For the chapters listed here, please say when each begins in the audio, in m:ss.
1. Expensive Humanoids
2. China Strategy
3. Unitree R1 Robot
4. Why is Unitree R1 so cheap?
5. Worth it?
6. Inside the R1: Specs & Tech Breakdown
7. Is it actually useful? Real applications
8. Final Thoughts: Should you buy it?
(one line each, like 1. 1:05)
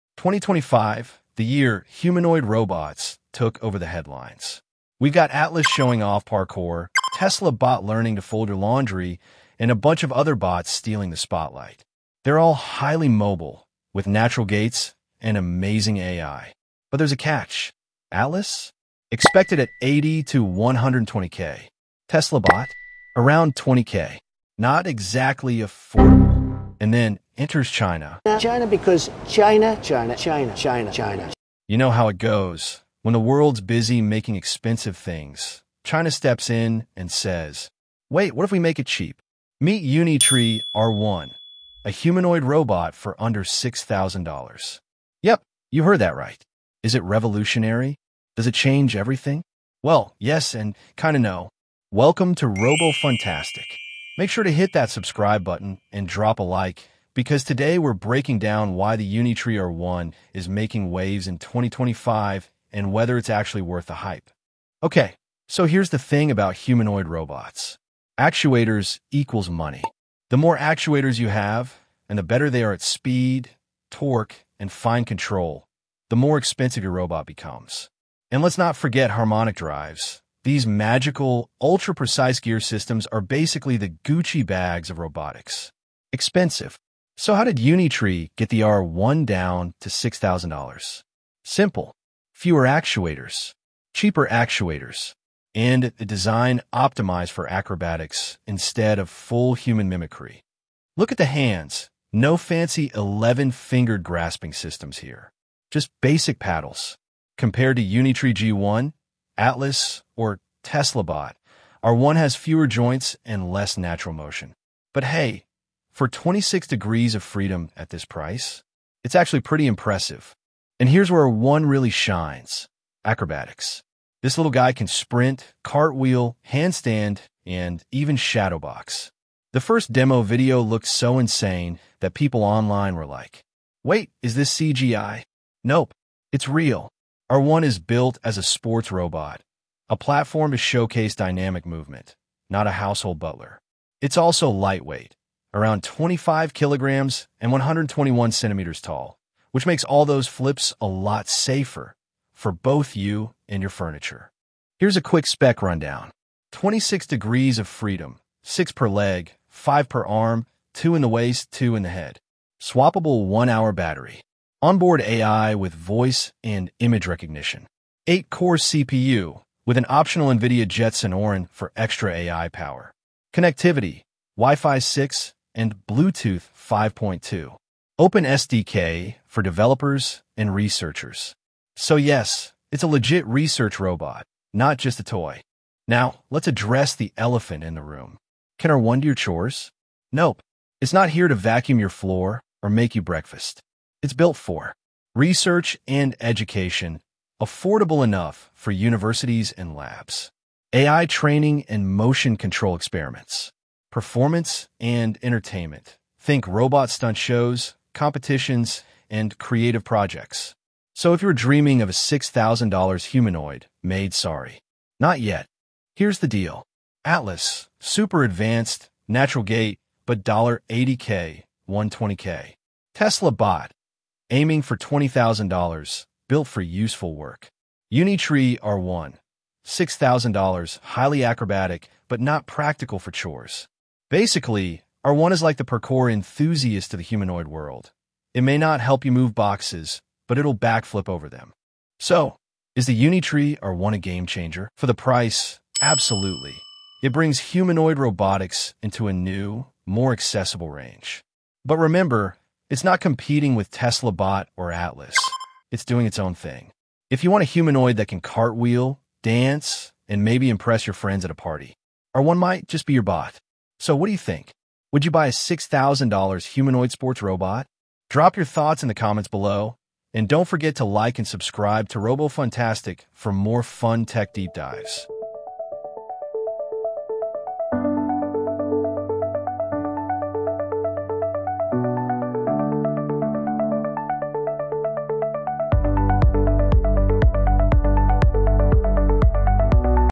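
1. 0:17
2. 0:28
3. 0:39
4. 1:05
5. 1:55
6. 2:23
7. 3:01
8. 4:24.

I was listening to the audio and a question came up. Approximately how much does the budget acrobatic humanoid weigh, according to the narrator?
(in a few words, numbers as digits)
25 kilograms.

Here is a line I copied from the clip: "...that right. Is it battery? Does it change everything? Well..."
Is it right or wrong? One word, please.
wrong.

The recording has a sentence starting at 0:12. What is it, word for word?
They're all highly mobile, with natural gaits and amazing AI.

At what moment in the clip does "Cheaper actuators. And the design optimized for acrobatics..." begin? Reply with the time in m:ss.
1:33.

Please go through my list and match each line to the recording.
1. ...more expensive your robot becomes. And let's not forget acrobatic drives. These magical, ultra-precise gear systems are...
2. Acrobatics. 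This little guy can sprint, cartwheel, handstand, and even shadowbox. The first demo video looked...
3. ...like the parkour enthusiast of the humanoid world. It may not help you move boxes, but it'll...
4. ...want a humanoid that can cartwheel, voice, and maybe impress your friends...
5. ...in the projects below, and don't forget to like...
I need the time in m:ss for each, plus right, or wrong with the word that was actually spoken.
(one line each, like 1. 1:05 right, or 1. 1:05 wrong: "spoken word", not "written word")
1. 1:16 wrong: "harmonic", not "acrobatic"
2. 2:03 right
3. 3:55 right
4. 4:17 wrong: "dance", not "voice"
5. 4:28 wrong: "comments", not "projects".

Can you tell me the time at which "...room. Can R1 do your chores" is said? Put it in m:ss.
3:07.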